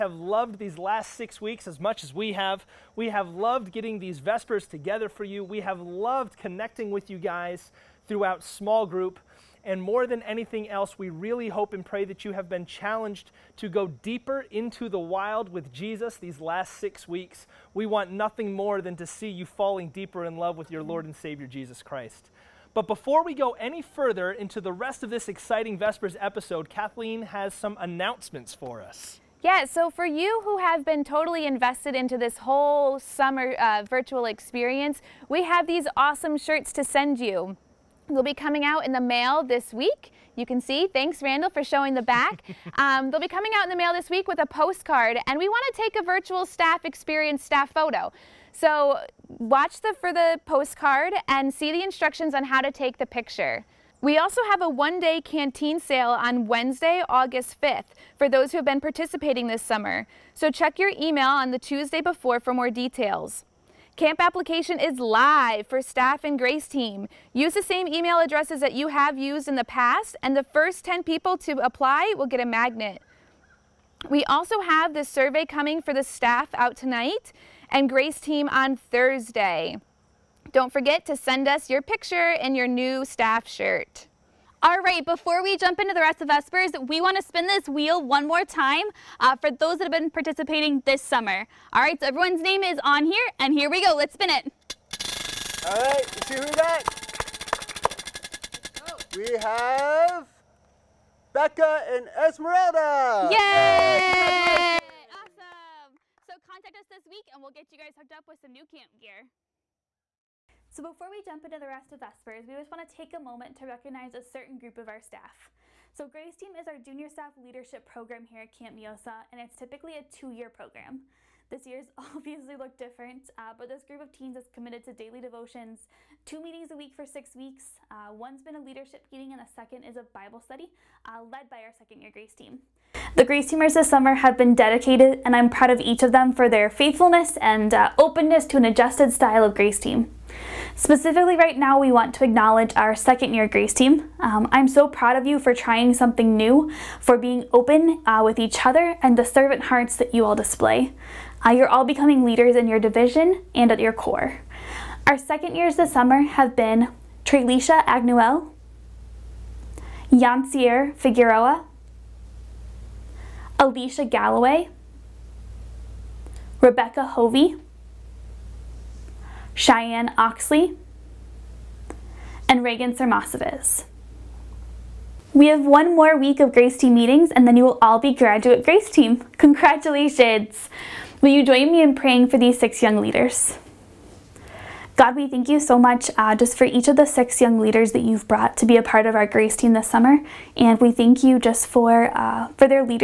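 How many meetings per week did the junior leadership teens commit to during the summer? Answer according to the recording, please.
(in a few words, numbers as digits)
2.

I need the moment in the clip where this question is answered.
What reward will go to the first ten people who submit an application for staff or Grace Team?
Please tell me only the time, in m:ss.
1:12.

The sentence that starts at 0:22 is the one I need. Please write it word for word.
But before we go any further into the rest of this exciting Vespers episode, Kathleen has some announcements for us.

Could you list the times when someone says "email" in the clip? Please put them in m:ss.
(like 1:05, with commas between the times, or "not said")
1:00, 1:07.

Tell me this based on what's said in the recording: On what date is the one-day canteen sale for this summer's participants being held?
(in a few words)
Wednesday, August 5th.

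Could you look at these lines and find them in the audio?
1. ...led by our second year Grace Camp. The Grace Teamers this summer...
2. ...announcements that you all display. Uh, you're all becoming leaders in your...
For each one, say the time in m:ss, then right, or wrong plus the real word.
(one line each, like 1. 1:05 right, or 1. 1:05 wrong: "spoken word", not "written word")
1. 2:11 wrong: "Team", not "Camp"
2. 2:29 wrong: "hearts", not "announcements".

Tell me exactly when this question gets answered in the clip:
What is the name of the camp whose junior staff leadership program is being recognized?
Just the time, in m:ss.
1:58.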